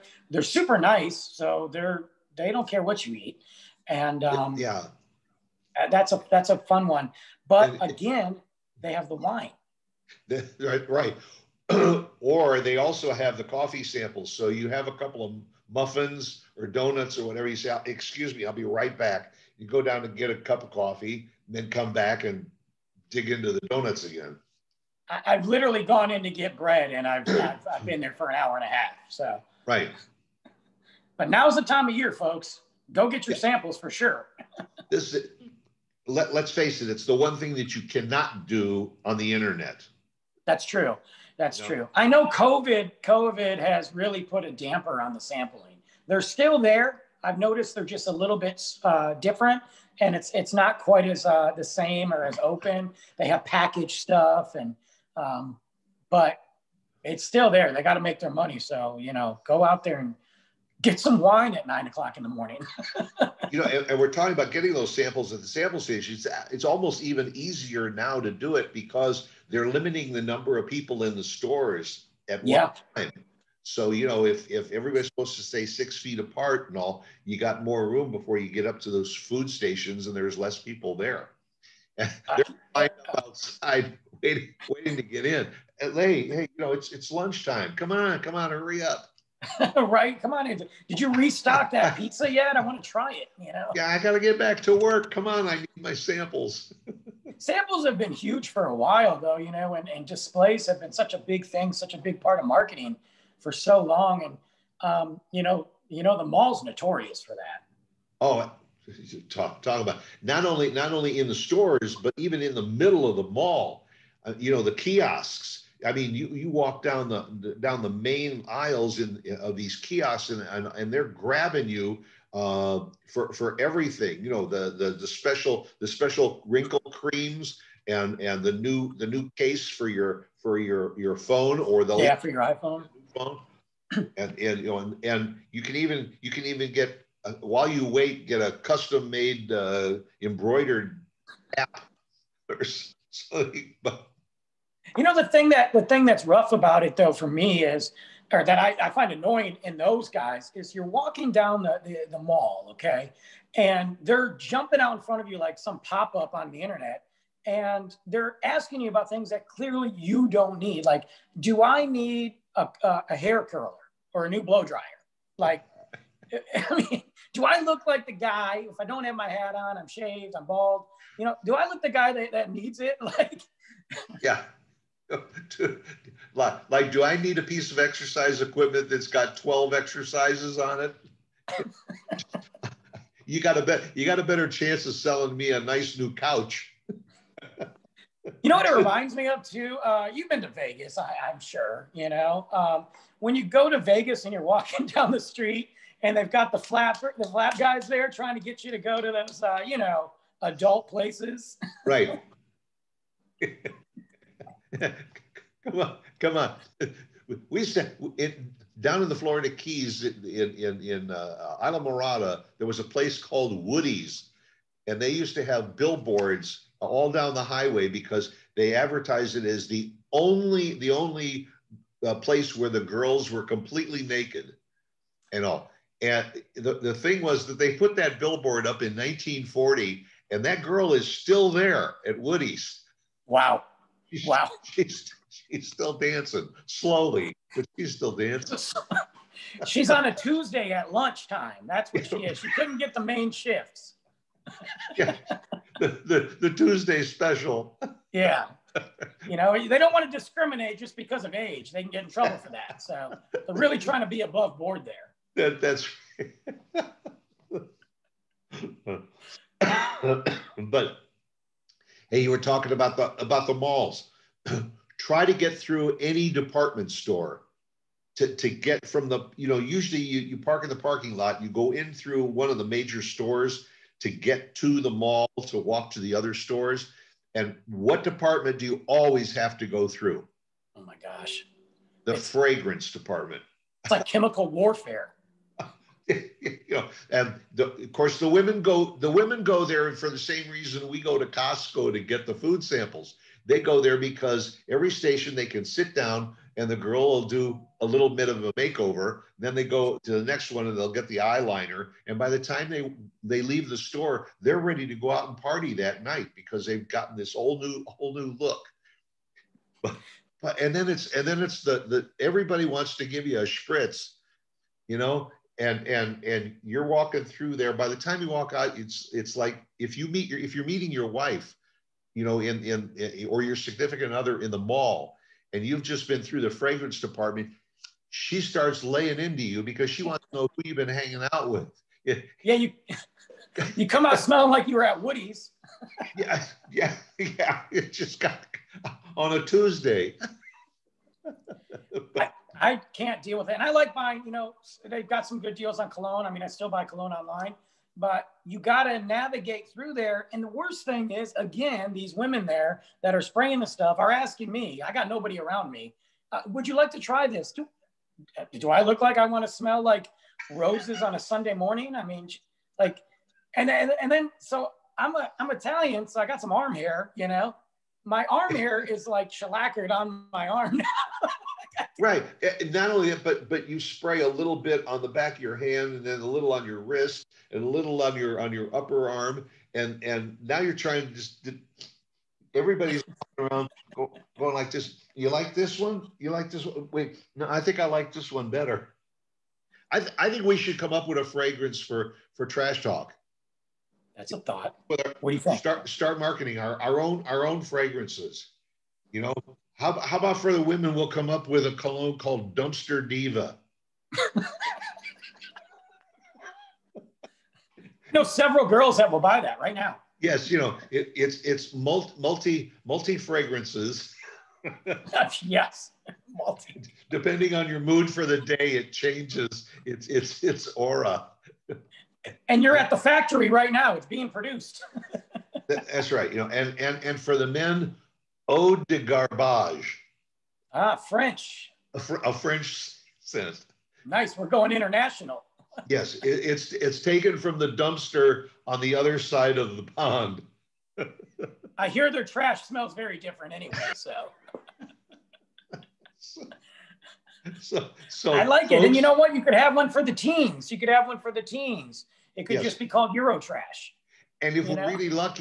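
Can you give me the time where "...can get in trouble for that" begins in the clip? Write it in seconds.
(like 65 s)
251 s.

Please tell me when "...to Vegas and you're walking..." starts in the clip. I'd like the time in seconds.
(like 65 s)
193 s.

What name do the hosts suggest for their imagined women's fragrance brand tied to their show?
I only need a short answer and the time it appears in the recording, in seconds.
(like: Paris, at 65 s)
Dumpster Diva, at 402 s.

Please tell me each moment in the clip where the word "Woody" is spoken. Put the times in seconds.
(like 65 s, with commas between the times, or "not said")
213 s, 232 s, 335 s.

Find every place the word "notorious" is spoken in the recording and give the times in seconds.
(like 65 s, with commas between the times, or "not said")
106 s.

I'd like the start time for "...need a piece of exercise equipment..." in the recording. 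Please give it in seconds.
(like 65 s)
177 s.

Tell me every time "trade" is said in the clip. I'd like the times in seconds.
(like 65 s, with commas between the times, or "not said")
not said.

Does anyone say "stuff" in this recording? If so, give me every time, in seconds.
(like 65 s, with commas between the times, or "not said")
53 s, 353 s.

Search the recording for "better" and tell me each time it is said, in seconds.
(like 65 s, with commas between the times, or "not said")
184 s, 388 s.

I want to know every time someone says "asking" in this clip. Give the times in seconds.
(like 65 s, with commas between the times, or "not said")
158 s, 354 s.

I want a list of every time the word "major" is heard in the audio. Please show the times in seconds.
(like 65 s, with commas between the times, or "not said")
272 s.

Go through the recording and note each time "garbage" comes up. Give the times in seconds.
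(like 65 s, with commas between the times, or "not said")
428 s.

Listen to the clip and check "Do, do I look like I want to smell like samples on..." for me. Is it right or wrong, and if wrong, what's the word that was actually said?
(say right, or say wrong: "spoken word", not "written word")
wrong: "roses", not "samples".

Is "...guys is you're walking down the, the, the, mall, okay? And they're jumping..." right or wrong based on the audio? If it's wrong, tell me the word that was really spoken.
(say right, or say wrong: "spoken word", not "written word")
right.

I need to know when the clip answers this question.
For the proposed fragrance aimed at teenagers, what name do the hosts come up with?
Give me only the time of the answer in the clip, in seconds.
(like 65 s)
453 s.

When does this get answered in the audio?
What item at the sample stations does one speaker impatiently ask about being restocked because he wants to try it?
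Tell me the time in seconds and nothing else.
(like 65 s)
91 s.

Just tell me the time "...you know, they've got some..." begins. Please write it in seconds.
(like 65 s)
344 s.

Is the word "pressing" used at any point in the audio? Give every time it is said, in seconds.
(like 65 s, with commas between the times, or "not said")
not said.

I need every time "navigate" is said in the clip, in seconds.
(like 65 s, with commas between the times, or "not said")
348 s.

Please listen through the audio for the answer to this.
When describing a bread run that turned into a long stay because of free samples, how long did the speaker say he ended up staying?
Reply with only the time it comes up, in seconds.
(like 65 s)
28 s.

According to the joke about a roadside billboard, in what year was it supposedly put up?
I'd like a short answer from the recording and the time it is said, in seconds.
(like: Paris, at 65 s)
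1940, at 228 s.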